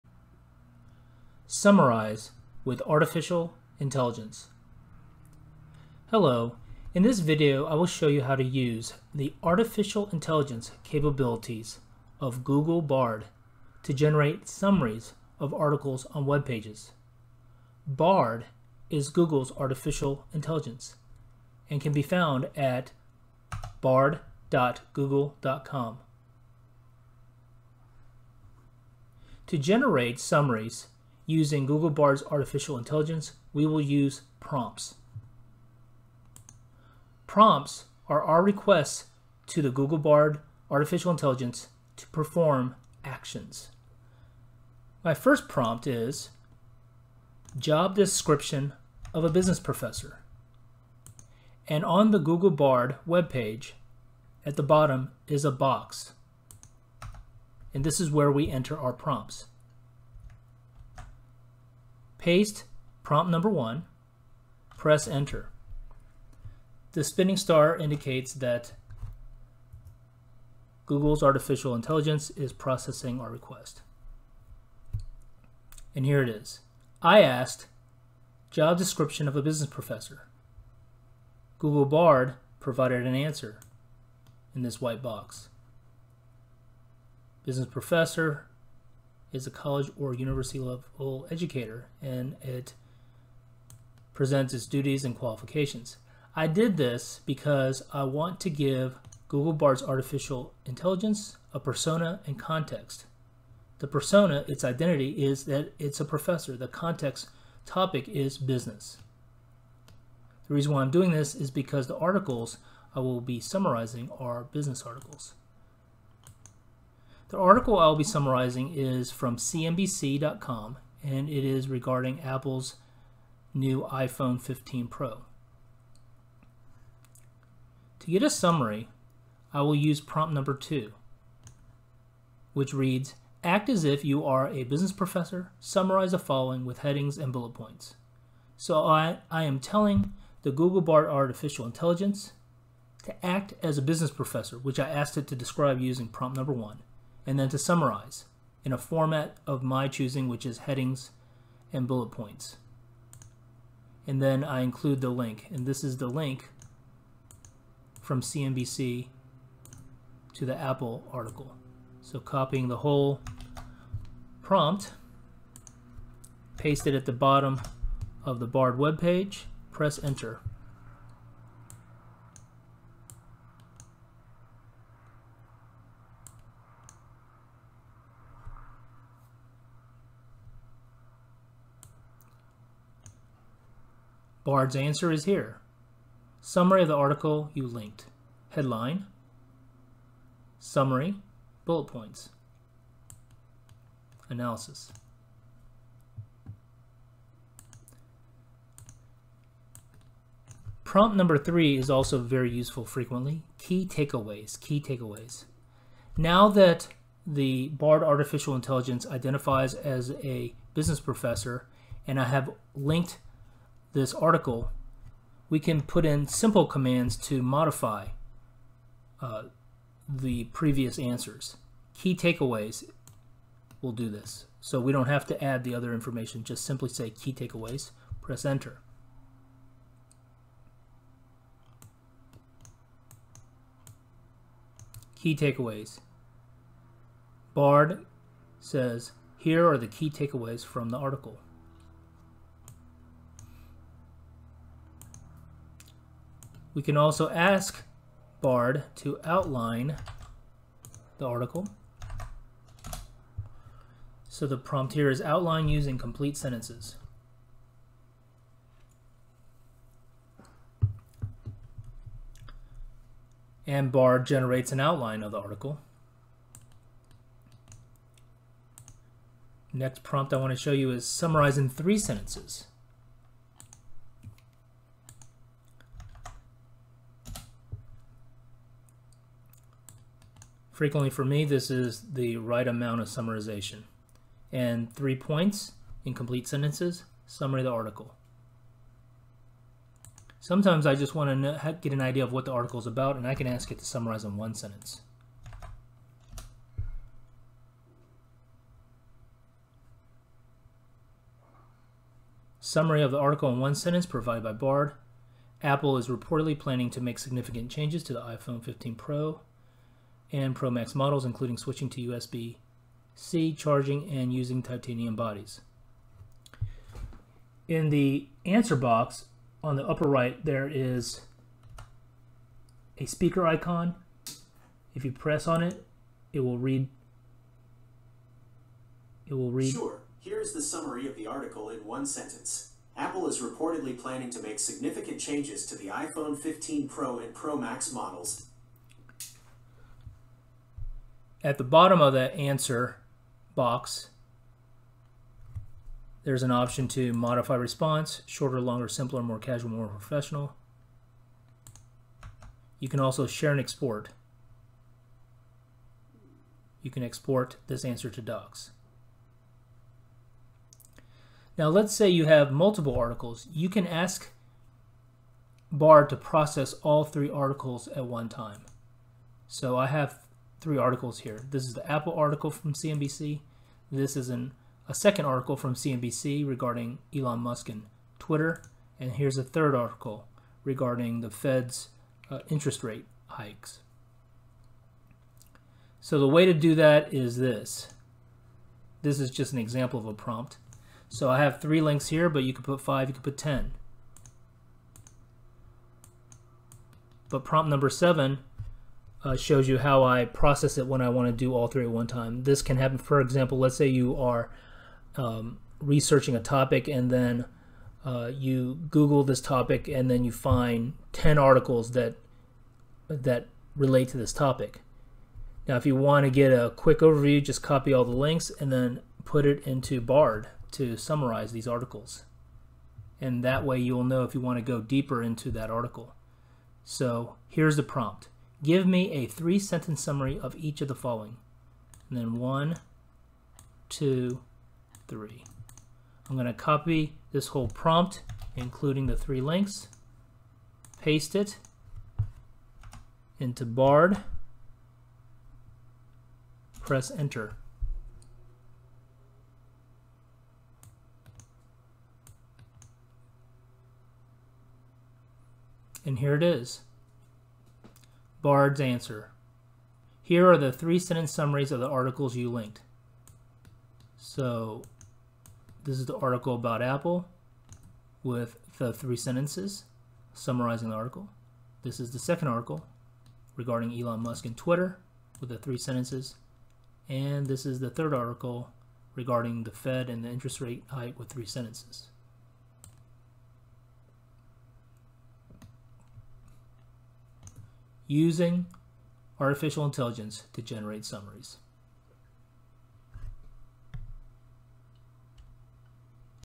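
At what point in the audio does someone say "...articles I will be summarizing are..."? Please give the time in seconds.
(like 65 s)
111 s.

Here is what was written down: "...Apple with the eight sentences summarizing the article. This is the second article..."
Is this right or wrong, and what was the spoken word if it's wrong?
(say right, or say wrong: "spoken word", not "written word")
wrong: "three", not "eight".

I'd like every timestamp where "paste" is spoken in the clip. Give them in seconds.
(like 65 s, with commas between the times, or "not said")
62 s, 166 s, 441 s.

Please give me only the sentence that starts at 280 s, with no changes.
Frequently for me, this is the right amount of summarization.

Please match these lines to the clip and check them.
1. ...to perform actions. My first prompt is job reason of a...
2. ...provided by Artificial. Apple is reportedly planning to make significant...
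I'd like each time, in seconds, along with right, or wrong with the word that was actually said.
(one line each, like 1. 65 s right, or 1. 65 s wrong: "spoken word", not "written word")
1. 41 s wrong: "description", not "reason"
2. 304 s wrong: "Bard", not "Artificial".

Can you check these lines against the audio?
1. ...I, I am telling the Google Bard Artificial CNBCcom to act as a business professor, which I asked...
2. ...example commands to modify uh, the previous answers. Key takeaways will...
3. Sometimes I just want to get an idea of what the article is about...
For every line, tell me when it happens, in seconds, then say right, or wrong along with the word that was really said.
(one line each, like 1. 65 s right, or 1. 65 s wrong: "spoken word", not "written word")
1. 138 s wrong: "Intelligence", not "CNBCcom"
2. 216 s wrong: "simple", not "example"
3. 290 s right.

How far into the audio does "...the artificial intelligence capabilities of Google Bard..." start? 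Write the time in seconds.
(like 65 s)
9 s.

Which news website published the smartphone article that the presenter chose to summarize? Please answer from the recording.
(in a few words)
CNBC.com.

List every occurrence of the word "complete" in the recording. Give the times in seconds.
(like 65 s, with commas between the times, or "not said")
255 s, 286 s.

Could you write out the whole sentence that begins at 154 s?
And then I include the link, and this is the link from CNBC to the Apple article.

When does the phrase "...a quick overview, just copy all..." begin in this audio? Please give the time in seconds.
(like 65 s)
416 s.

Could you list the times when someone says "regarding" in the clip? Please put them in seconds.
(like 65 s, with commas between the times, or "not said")
121 s, 376 s, 380 s, 473 s, 479 s.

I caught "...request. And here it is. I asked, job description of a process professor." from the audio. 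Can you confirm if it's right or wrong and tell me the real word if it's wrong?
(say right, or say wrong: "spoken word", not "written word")
wrong: "business", not "process".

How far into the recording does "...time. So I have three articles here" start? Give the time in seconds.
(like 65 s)
368 s.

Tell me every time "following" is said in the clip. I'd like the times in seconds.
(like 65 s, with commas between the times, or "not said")
136 s, 430 s.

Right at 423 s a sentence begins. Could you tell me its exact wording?
And that way you'll know if you want to go deeper into that article.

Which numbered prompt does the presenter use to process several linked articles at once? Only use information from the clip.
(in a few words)
7.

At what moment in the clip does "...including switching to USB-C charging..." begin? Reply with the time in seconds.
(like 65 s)
311 s.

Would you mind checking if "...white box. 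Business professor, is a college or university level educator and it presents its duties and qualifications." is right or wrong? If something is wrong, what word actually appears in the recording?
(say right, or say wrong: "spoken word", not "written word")
right.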